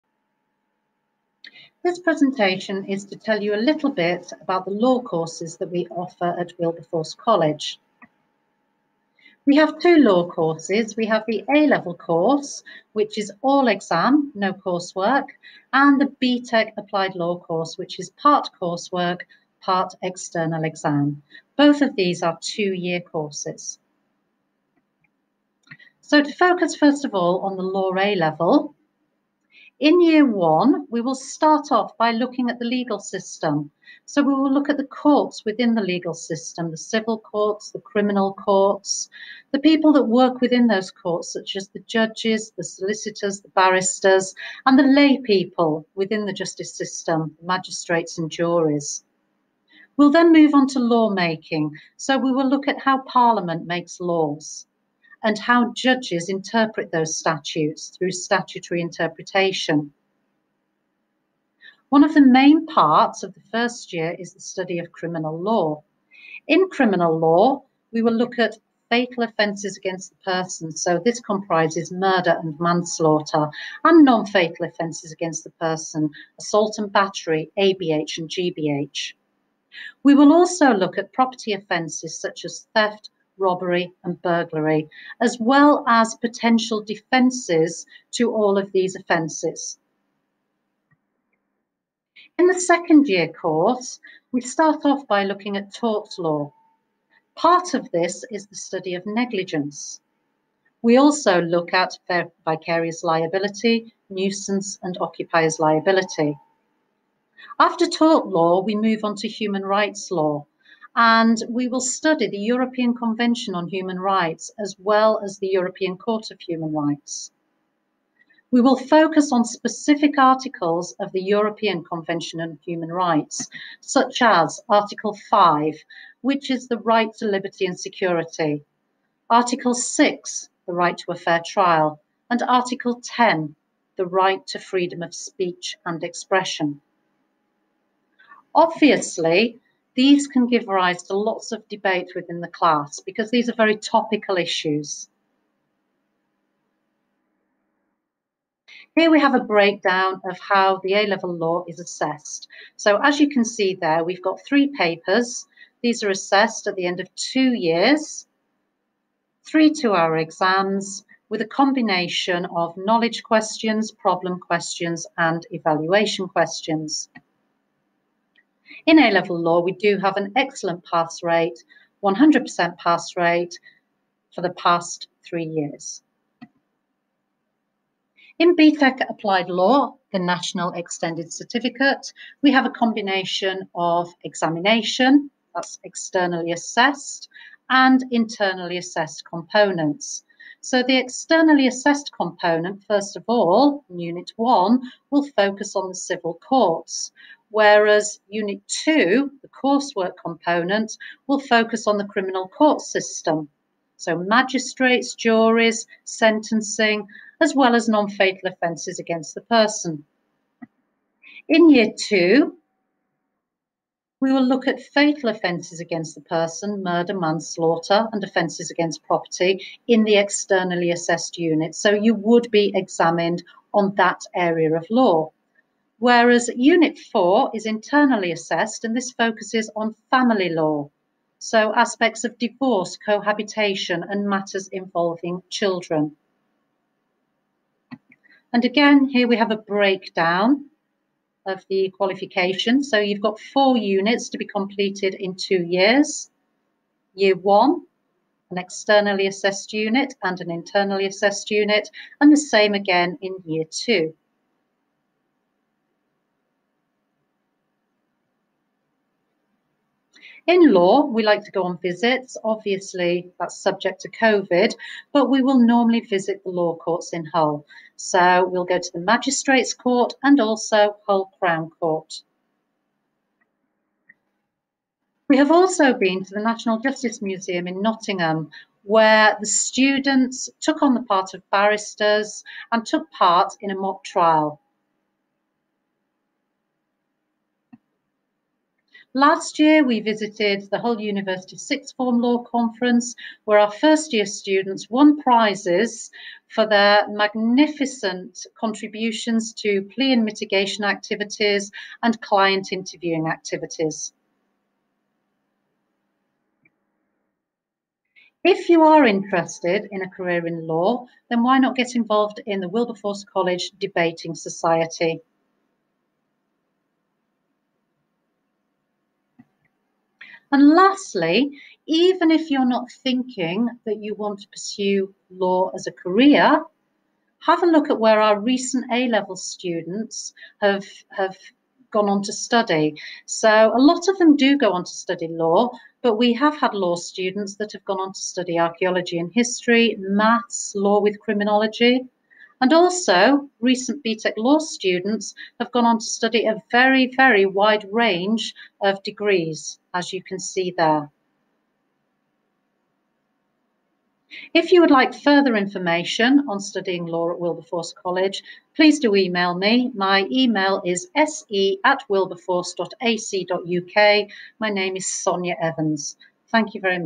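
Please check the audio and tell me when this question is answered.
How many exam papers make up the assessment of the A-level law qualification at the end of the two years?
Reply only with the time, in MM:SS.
02:34.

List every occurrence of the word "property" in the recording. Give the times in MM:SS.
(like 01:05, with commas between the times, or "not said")
01:21, 03:39.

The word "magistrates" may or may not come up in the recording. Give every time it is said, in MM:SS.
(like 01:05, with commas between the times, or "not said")
00:47, 03:24, 04:29.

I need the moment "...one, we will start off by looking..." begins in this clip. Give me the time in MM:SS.
00:30.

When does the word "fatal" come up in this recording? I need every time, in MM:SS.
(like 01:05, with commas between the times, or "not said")
01:08, 01:14, 03:28, 03:34.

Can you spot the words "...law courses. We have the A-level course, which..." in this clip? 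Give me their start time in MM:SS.
00:09.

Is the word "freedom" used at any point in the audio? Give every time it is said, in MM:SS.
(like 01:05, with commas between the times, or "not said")
02:14.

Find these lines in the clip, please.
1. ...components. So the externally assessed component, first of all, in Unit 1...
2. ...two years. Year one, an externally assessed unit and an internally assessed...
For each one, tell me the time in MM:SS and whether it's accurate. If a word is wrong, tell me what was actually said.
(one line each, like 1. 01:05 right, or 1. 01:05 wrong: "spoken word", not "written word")
1. 03:09 right
2. 04:05 right.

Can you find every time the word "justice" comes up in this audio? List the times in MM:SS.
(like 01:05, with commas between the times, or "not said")
00:46, 04:36.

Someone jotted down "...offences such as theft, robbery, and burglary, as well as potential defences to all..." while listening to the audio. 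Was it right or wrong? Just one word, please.
right.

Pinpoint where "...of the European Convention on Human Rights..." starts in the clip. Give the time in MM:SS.
02:00.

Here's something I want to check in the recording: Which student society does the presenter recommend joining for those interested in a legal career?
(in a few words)
Debating Society.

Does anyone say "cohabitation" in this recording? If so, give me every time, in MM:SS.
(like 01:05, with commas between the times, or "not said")
03:52.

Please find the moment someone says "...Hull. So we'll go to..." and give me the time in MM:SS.
04:27.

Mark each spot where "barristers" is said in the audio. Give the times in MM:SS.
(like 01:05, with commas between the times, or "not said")
00:43, 04:41.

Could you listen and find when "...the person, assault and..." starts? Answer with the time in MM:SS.
01:15.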